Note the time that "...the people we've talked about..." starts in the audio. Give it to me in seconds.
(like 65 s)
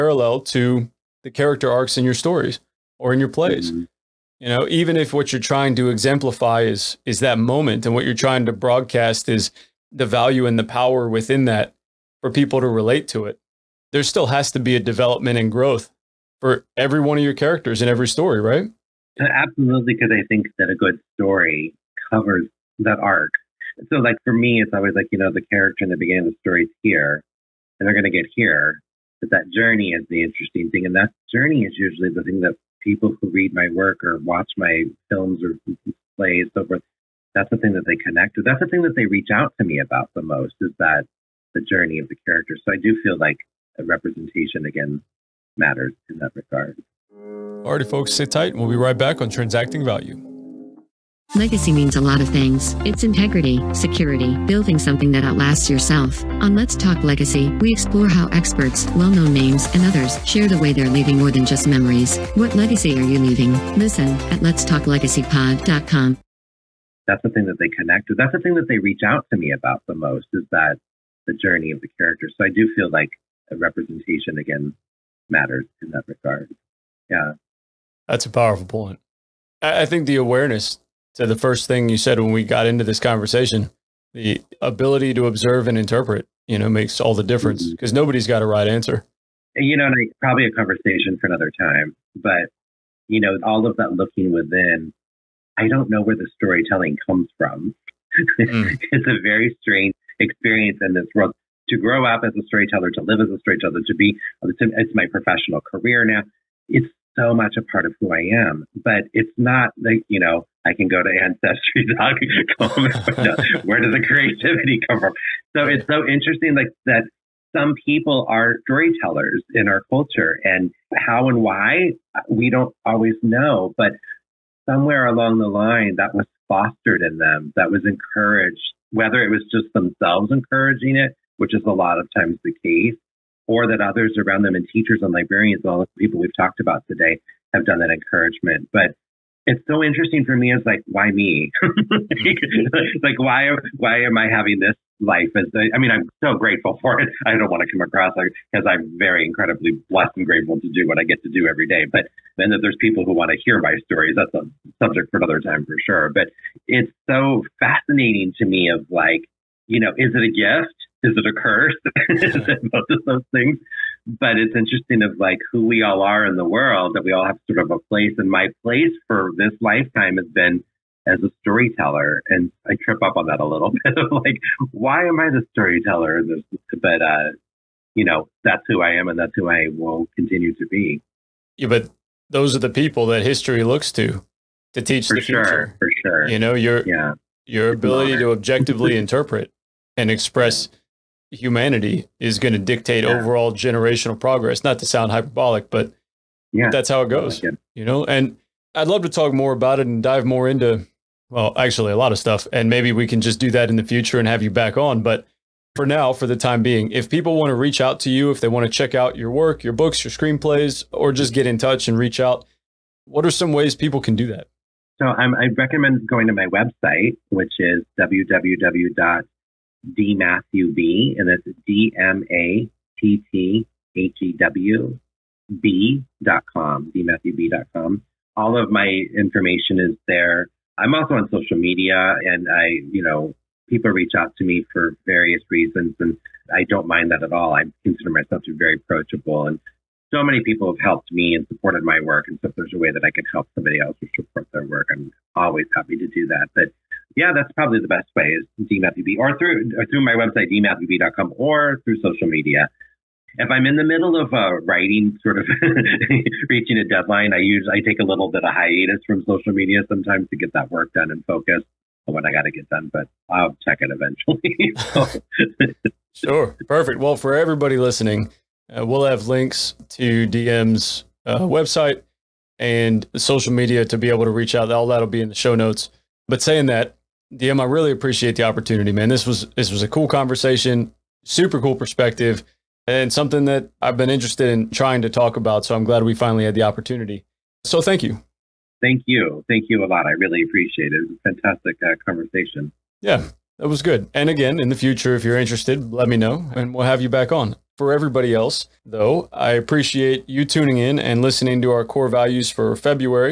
135 s.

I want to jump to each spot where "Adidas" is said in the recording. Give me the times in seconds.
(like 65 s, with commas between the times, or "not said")
not said.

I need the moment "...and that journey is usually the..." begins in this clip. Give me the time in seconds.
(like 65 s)
30 s.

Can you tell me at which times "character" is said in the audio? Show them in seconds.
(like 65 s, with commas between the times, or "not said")
1 s, 17 s, 25 s, 42 s, 71 s.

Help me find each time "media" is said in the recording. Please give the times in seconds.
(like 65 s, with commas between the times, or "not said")
231 s, 252 s, 259 s, 273 s.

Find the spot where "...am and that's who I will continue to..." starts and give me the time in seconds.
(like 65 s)
178 s.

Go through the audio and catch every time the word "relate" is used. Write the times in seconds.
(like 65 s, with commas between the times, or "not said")
12 s.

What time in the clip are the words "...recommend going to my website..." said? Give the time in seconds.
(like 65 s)
215 s.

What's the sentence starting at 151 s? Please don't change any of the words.
But then that there's people who want to hear my stories.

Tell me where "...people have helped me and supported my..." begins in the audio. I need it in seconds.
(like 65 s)
240 s.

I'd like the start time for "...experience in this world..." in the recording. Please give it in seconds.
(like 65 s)
100 s.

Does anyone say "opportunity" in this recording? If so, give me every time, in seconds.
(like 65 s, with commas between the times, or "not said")
278 s, 286 s.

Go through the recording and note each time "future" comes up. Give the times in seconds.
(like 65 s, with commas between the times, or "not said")
185 s, 203 s, 294 s.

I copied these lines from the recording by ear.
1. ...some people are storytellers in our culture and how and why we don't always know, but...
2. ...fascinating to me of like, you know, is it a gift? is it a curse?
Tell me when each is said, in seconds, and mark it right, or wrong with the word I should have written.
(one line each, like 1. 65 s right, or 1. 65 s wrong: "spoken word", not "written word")
1. 117 s right
2. 157 s right.